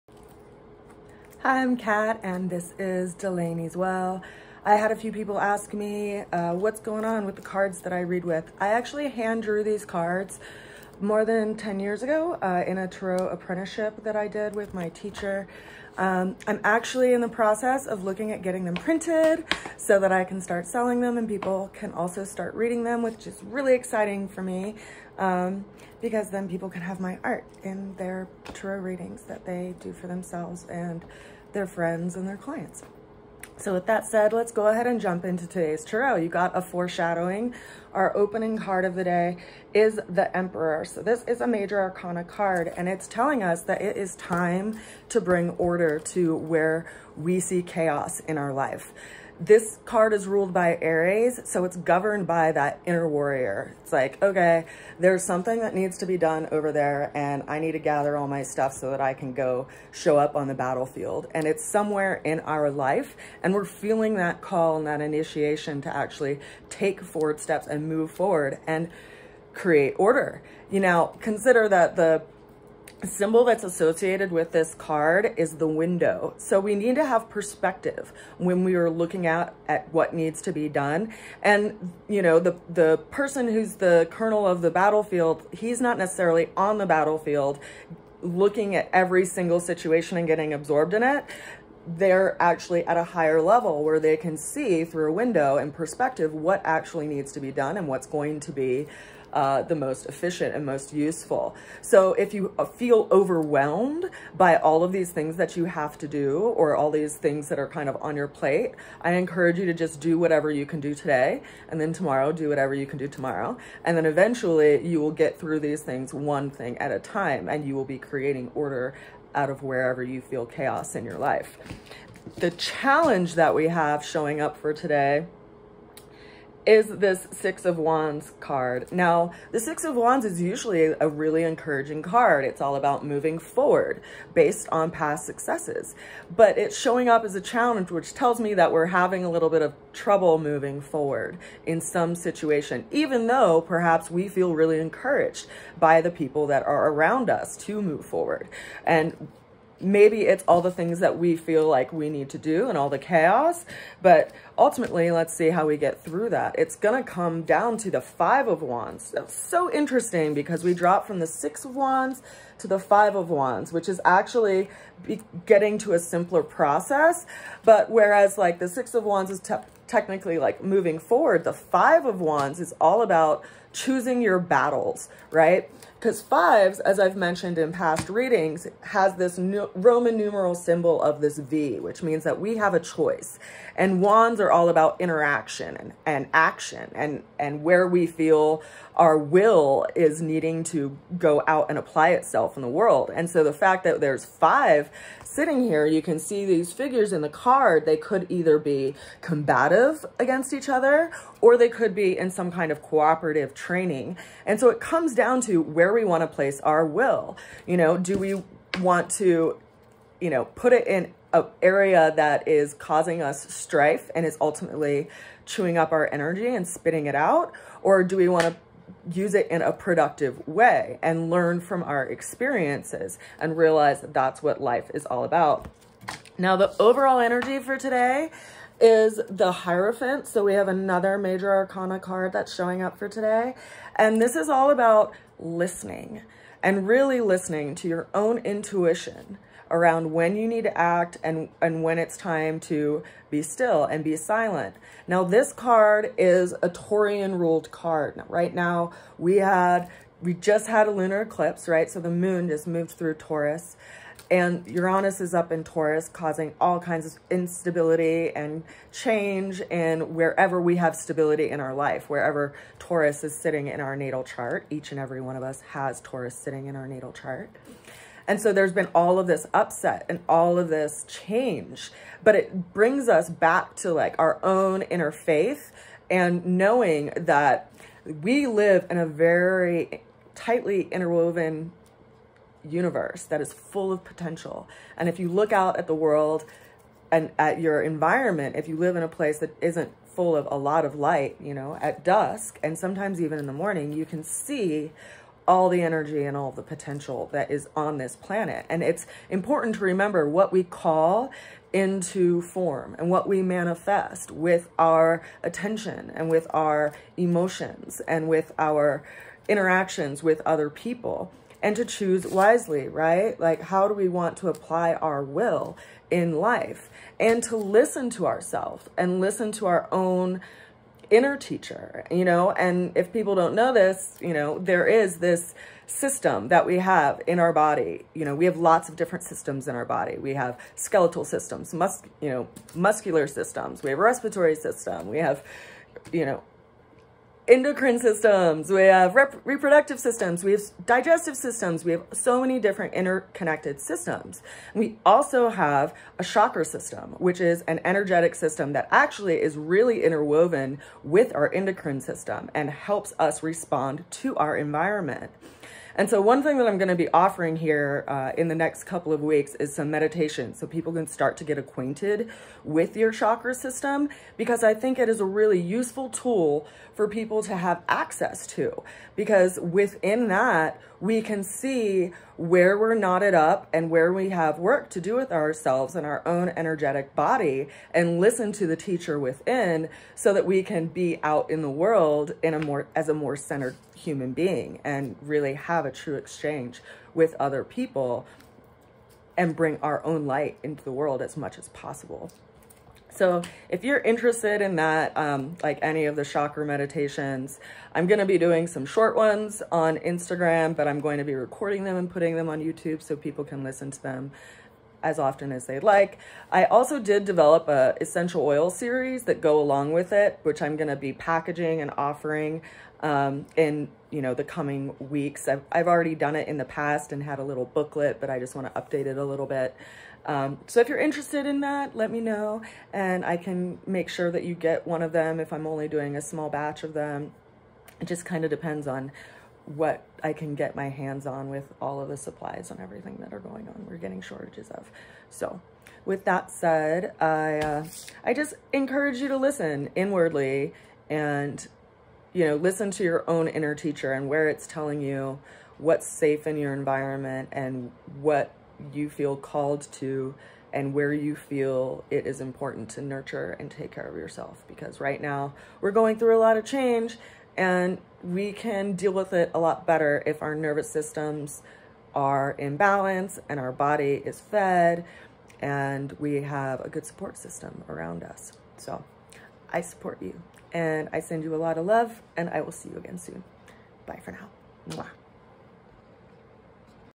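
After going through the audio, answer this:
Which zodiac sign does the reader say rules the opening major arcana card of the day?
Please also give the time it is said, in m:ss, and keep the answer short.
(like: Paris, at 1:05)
Aries, at 0:50.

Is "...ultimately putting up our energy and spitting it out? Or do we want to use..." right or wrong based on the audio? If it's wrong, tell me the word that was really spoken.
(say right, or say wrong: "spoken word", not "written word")
wrong: "chewing", not "putting".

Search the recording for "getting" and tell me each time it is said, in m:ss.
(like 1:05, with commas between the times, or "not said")
0:18, 1:30, 2:45, 7:13.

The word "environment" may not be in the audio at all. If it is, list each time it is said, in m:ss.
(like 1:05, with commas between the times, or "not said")
4:47, 5:54, 7:26.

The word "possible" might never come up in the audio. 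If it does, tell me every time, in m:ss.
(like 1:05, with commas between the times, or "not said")
6:31.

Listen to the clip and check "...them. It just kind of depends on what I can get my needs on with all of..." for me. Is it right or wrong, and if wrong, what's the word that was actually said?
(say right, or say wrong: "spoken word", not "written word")
wrong: "hands", not "needs".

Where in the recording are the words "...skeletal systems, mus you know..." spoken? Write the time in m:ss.
5:30.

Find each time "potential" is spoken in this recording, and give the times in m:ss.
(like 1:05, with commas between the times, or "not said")
4:44, 4:56.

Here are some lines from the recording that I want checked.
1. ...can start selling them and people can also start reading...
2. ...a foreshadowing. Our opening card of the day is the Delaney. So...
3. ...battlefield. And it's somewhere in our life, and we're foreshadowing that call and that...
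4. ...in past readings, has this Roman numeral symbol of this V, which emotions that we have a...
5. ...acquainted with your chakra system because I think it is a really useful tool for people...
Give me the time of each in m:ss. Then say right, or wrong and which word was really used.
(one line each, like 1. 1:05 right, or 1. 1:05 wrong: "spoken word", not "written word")
1. 0:20 right
2. 0:36 wrong: "Emperor", not "Delaney"
3. 1:00 wrong: "feeling", not "foreshadowing"
4. 2:57 wrong: "means", not "emotions"
5. 6:01 right.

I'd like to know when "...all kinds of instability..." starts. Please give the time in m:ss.
4:16.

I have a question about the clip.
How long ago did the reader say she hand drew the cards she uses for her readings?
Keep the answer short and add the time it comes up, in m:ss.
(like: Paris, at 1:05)
More than 10 years ago, at 0:11.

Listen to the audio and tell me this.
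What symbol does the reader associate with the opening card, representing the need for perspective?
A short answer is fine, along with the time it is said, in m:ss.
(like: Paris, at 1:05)
The window, at 1:15.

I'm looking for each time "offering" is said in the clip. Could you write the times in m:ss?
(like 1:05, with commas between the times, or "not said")
5:57, 6:51.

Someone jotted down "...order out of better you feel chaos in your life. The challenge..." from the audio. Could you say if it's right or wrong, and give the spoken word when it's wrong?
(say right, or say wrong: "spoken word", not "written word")
wrong: "wherever", not "better".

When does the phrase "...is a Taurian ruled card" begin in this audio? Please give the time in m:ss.
4:06.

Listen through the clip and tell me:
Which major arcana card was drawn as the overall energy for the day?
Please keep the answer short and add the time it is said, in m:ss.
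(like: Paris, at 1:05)
The Hierophant, at 3:49.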